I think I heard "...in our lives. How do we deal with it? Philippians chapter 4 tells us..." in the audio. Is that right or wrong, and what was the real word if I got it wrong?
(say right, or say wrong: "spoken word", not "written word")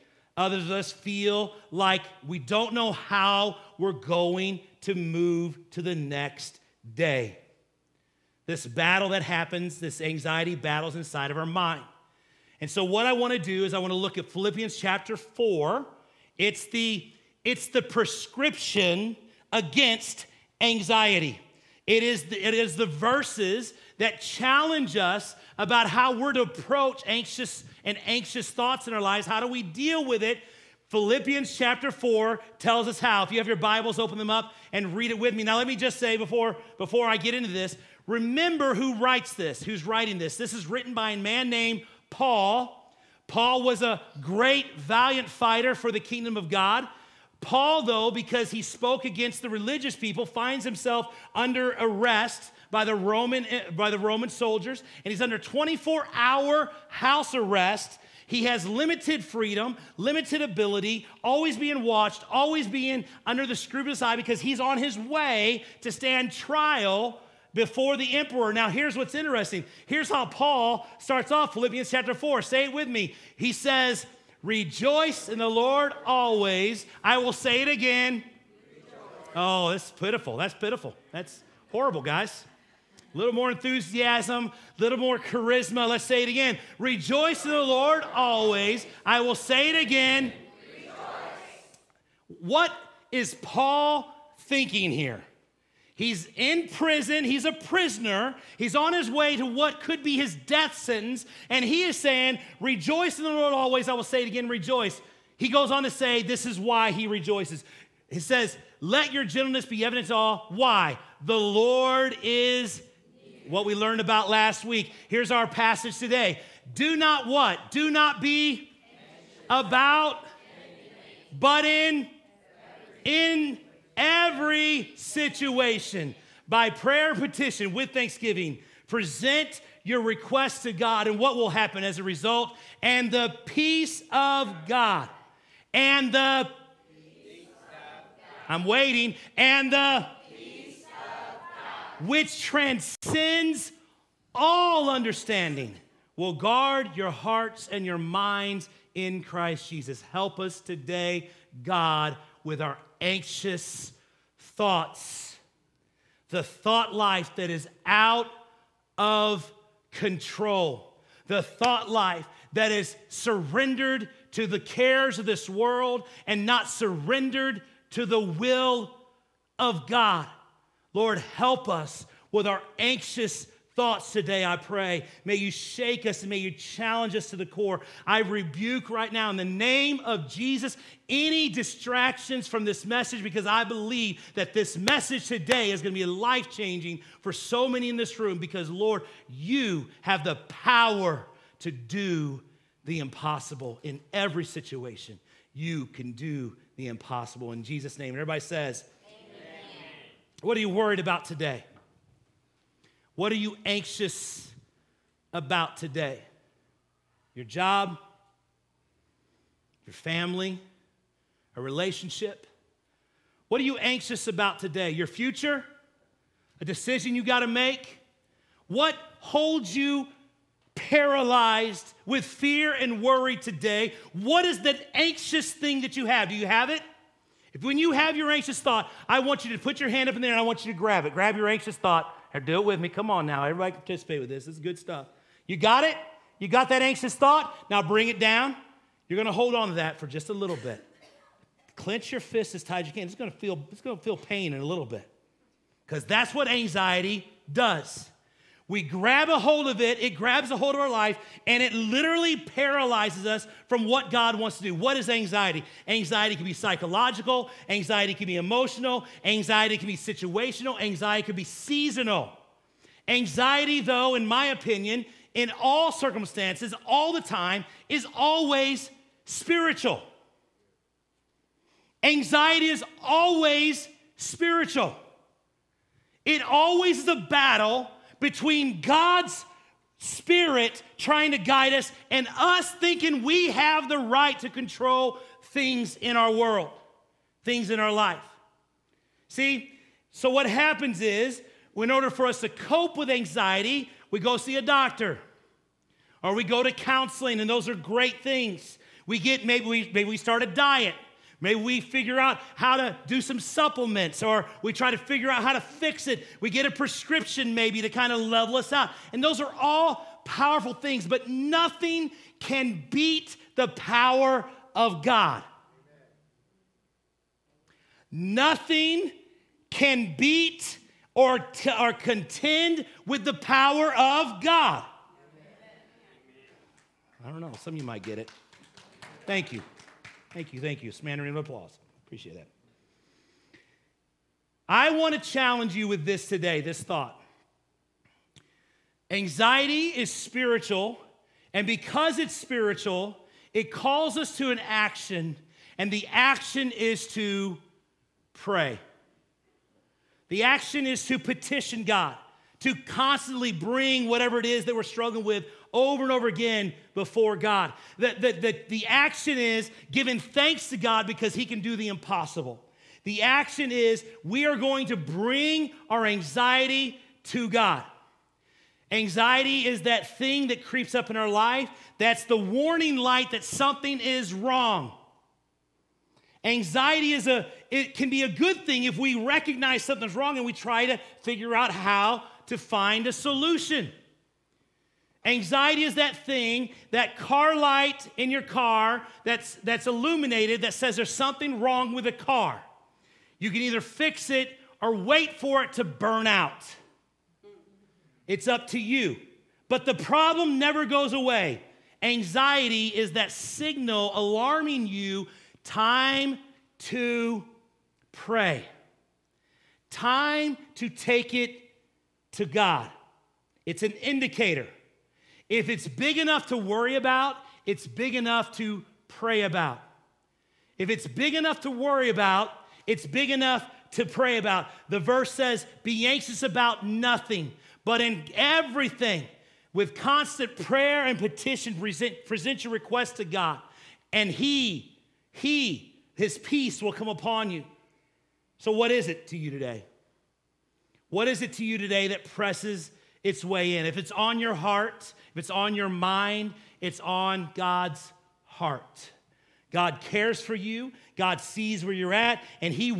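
right.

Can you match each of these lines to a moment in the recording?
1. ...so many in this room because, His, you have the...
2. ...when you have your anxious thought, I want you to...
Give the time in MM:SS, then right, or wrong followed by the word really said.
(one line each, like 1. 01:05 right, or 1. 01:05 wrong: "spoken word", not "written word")
1. 03:07 wrong: "Lord", not "His"
2. 03:47 right.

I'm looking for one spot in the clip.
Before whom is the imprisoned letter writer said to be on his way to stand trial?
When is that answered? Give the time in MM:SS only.
01:07.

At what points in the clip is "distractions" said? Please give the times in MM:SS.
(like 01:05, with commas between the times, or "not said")
03:01.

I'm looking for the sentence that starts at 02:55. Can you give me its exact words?
May you shake us and may you challenge us to the core.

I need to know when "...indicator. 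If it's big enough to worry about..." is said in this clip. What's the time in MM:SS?
06:53.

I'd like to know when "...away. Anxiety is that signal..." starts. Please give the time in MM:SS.
06:41.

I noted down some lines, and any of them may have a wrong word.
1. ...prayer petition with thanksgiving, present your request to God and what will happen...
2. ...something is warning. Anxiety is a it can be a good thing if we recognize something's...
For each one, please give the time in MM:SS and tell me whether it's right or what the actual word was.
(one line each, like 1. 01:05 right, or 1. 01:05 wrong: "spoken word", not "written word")
1. 02:06 right
2. 06:13 wrong: "wrong", not "warning".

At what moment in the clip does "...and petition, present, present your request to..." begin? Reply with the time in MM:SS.
07:11.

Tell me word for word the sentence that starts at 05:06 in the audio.
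We get a prescription maybe to kind of level us out.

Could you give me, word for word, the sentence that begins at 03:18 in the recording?
And everybody says, What are you worried about today?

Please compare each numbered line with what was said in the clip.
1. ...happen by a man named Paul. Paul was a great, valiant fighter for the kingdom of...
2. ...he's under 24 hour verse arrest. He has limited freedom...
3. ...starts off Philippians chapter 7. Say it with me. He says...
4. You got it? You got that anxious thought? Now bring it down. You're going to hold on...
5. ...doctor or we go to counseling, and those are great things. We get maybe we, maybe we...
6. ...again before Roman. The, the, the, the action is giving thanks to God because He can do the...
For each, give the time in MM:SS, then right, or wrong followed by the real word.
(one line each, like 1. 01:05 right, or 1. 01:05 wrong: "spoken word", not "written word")
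1. 00:40 wrong: "written", not "happen"
2. 00:55 wrong: "house", not "verse"
3. 01:10 wrong: "4", not "7"
4. 03:55 right
5. 04:54 right
6. 05:56 wrong: "God", not "Roman".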